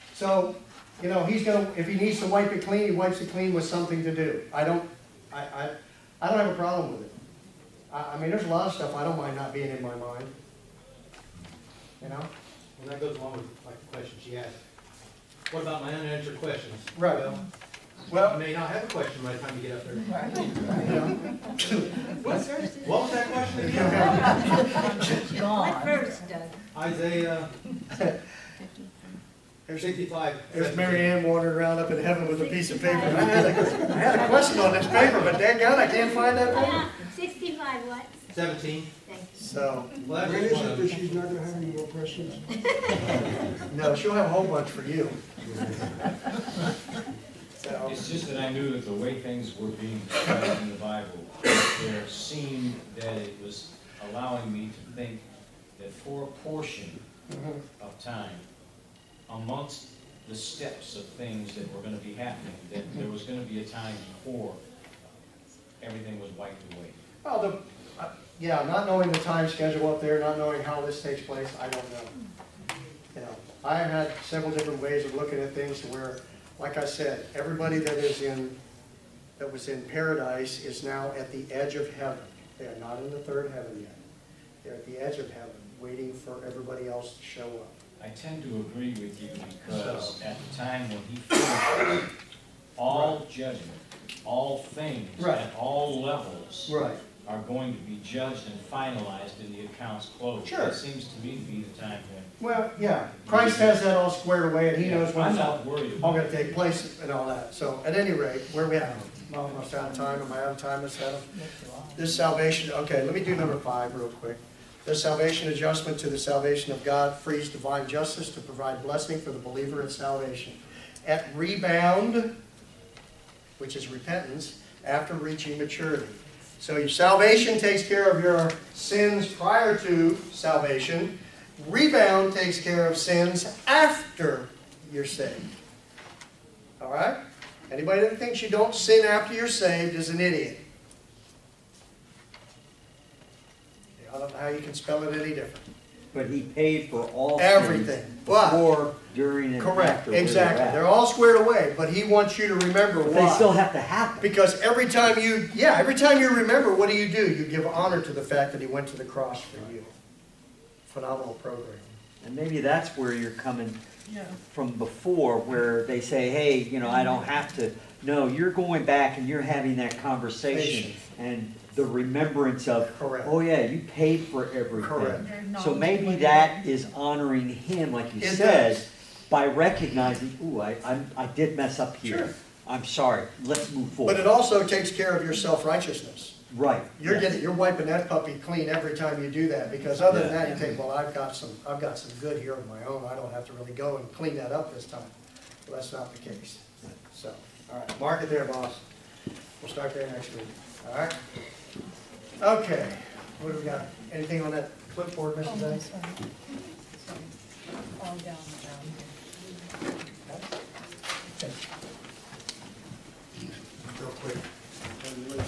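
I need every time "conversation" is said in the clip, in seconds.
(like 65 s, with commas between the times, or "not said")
170 s.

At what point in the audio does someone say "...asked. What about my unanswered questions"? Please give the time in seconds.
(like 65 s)
14 s.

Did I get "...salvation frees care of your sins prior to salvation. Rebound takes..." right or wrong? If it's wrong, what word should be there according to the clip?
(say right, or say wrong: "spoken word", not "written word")
wrong: "takes", not "frees".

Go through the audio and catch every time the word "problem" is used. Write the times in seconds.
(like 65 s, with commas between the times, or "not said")
6 s.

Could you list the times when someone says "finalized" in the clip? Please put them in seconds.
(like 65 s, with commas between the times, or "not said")
98 s.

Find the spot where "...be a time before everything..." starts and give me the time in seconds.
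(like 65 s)
63 s.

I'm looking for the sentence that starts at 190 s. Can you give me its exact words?
than that you think, well, I've got some I've got some good here of my own.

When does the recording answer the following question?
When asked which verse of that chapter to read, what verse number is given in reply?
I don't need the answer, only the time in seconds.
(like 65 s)
38 s.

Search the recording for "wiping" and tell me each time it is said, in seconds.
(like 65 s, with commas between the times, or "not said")
187 s.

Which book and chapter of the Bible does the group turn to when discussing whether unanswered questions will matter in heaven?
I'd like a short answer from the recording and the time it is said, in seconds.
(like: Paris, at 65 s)
Isaiah 65, at 26 s.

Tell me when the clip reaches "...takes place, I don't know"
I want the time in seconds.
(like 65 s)
71 s.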